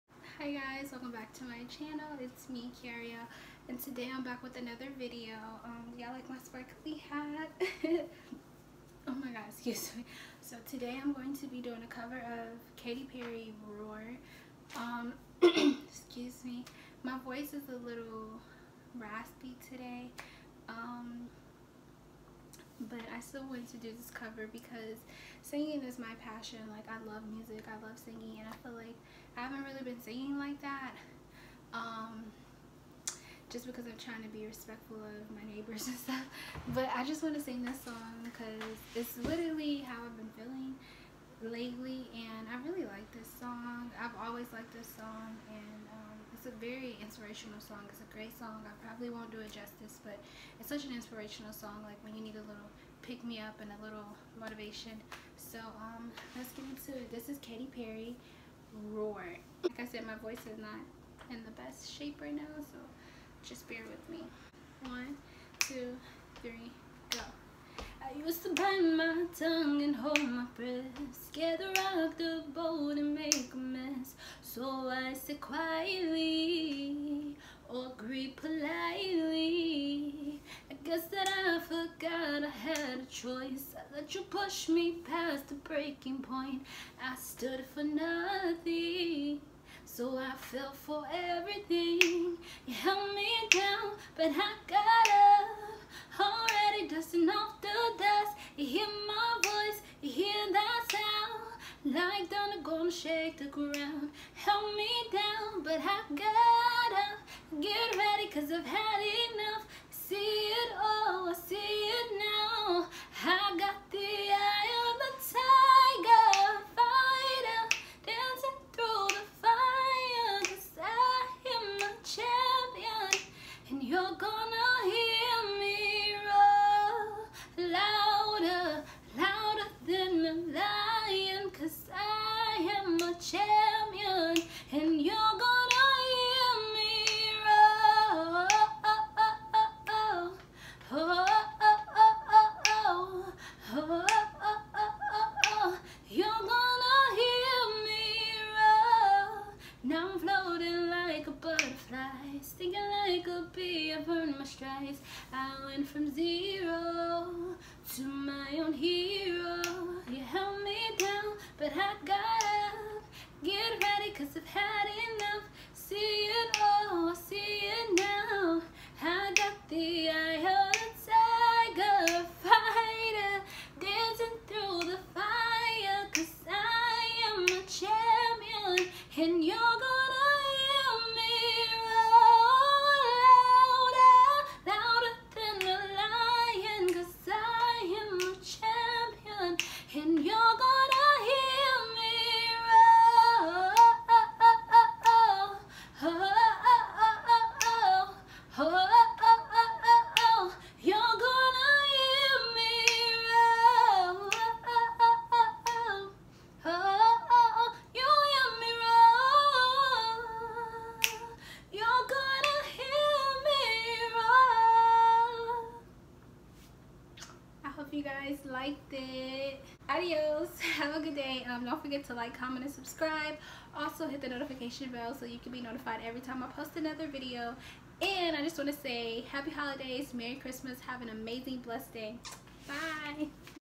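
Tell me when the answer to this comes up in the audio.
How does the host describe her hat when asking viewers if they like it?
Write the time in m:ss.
0:06.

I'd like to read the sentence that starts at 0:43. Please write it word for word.
I've always liked this song and um, it's a very inspirational song.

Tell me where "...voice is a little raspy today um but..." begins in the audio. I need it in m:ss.
0:17.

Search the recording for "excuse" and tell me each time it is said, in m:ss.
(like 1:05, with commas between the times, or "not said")
0:09, 0:15.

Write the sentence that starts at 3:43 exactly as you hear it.
Also, hit the notification bell so you can be notified every time I post another video.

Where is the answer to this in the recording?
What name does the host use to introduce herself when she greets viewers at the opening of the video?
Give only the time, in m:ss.
0:02.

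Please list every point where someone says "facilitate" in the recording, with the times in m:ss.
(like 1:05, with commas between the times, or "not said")
not said.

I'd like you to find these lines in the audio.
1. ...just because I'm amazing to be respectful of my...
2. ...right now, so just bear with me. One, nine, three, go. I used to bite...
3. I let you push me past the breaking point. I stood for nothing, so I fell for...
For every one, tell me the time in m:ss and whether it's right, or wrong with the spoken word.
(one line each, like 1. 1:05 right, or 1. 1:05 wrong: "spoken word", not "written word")
1. 0:33 wrong: "trying", not "amazing"
2. 1:02 wrong: "two", not "nine"
3. 1:23 right.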